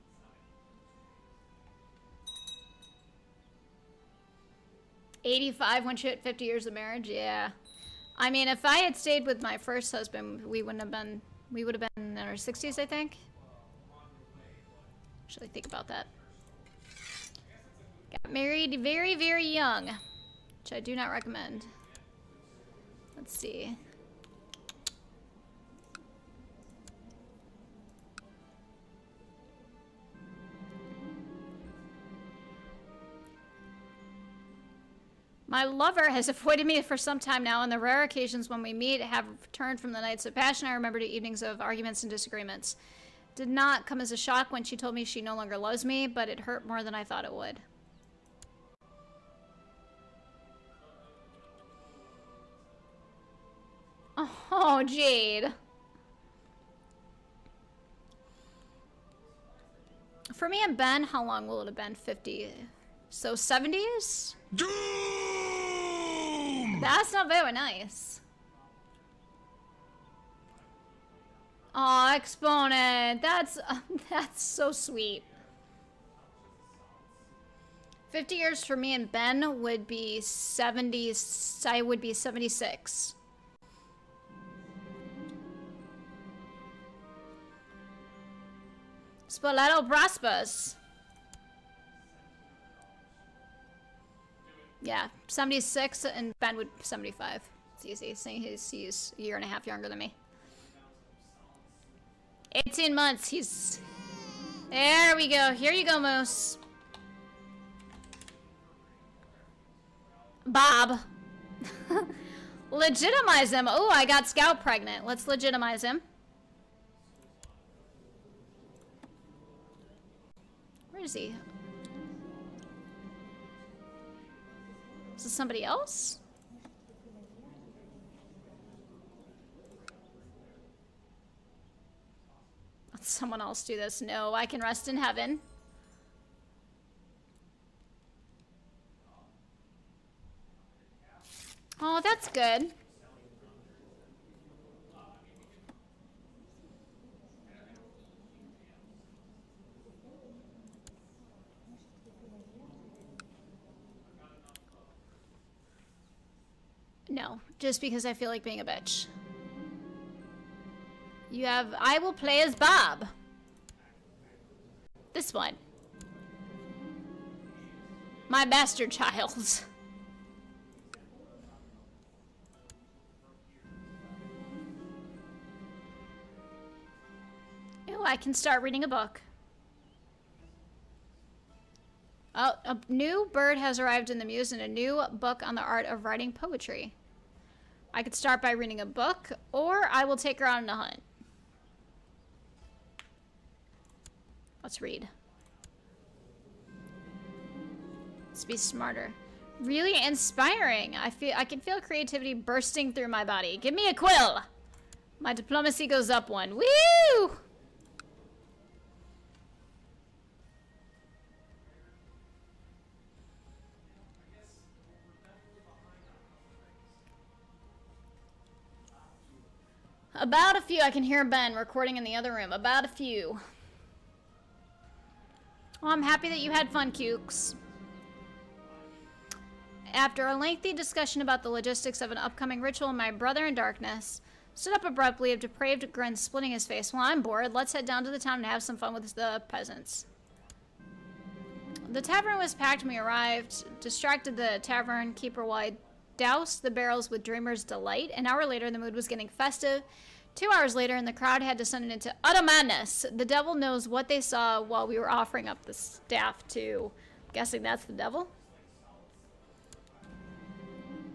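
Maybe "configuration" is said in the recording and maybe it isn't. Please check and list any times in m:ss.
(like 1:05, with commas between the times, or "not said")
not said.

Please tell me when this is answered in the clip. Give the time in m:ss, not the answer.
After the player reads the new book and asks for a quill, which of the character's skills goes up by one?
3:25.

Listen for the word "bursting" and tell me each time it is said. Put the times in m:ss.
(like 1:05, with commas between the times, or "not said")
3:22.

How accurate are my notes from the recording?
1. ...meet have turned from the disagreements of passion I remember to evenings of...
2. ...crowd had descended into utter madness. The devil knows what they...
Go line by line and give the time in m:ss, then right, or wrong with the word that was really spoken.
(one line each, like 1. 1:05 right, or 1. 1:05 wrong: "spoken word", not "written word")
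1. 0:38 wrong: "nights", not "disagreements"
2. 4:11 right.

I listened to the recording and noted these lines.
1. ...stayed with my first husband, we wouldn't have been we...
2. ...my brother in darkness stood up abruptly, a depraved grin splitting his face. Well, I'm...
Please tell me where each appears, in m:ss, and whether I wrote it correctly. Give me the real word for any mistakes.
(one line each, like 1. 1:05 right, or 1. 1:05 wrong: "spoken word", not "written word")
1. 0:08 right
2. 3:52 right.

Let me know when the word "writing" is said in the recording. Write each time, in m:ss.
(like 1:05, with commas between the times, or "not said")
3:06.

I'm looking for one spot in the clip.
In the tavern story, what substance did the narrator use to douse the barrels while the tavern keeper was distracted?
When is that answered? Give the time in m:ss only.
4:07.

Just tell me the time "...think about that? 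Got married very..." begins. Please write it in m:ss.
0:15.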